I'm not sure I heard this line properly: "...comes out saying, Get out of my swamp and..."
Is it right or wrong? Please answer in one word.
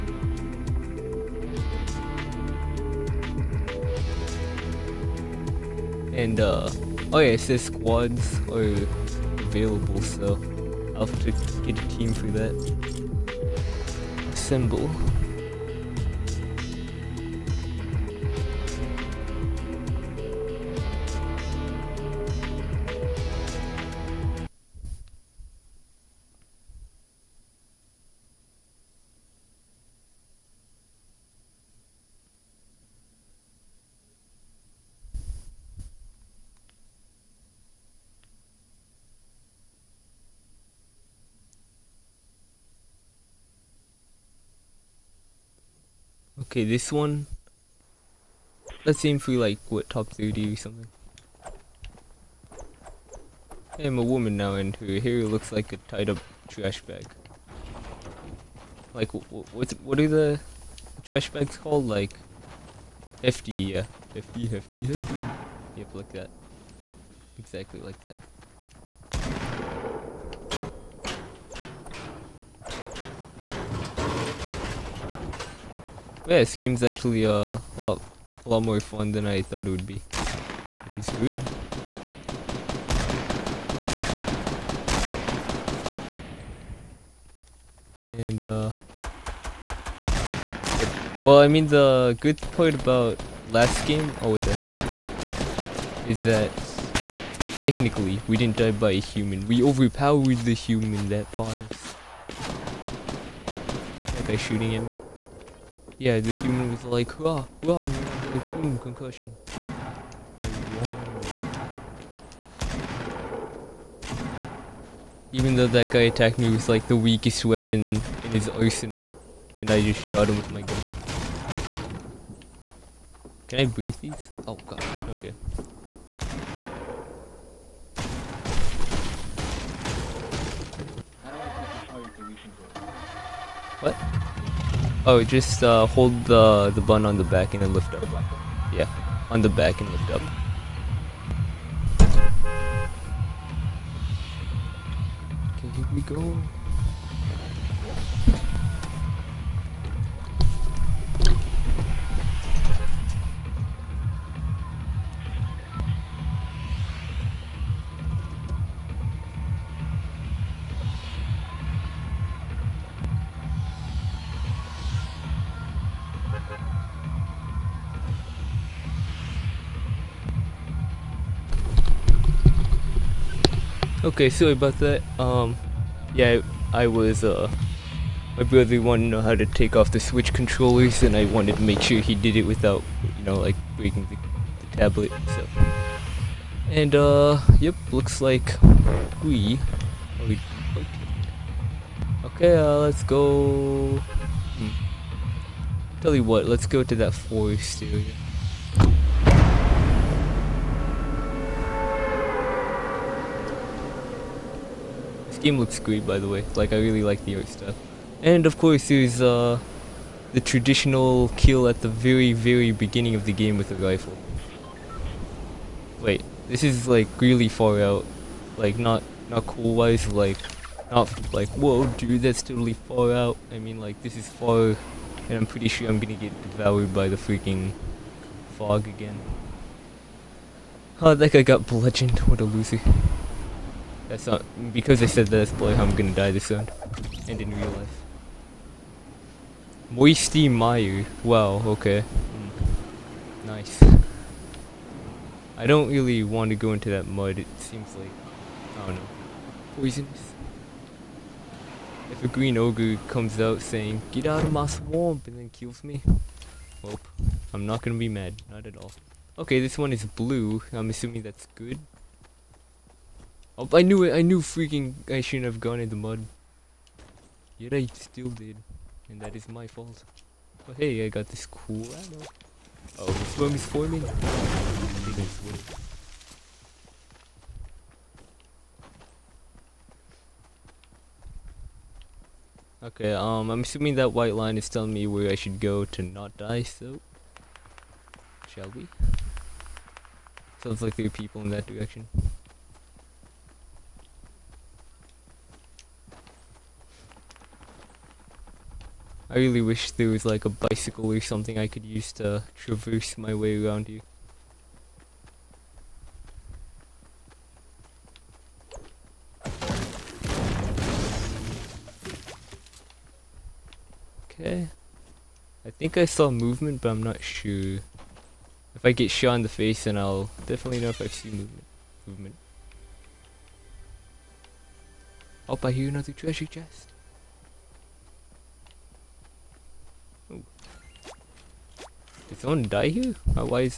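right.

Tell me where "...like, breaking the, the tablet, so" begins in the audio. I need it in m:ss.
3:03.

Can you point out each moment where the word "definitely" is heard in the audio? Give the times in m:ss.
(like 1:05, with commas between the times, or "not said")
5:20.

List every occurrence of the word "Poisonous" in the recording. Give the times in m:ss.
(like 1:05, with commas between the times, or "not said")
4:09.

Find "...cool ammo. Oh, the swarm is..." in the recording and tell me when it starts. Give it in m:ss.
4:31.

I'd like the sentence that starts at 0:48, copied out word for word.
Let's see if we like, what, top 30 or something.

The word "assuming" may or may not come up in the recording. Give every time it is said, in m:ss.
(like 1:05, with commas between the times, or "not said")
4:20, 4:43.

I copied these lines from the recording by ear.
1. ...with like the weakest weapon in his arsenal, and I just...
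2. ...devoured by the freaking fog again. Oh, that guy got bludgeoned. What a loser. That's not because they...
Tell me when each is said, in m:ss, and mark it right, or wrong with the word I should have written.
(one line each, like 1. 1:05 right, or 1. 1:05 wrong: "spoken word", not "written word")
1. 1:56 right
2. 3:46 right.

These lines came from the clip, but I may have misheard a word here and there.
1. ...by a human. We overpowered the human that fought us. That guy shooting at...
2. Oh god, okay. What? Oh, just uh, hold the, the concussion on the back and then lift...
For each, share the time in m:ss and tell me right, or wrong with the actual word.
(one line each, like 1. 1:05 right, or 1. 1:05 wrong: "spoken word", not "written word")
1. 1:38 right
2. 2:04 wrong: "button", not "concussion".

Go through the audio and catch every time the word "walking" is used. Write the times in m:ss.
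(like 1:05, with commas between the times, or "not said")
not said.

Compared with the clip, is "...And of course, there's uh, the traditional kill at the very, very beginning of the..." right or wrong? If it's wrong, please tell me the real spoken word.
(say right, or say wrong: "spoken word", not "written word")
right.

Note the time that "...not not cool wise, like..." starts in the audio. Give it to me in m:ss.
3:38.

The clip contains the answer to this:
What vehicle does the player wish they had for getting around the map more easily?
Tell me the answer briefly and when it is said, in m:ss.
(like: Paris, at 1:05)
bicycle, at 5:00.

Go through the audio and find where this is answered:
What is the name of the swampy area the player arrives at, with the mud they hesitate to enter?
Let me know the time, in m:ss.
3:59.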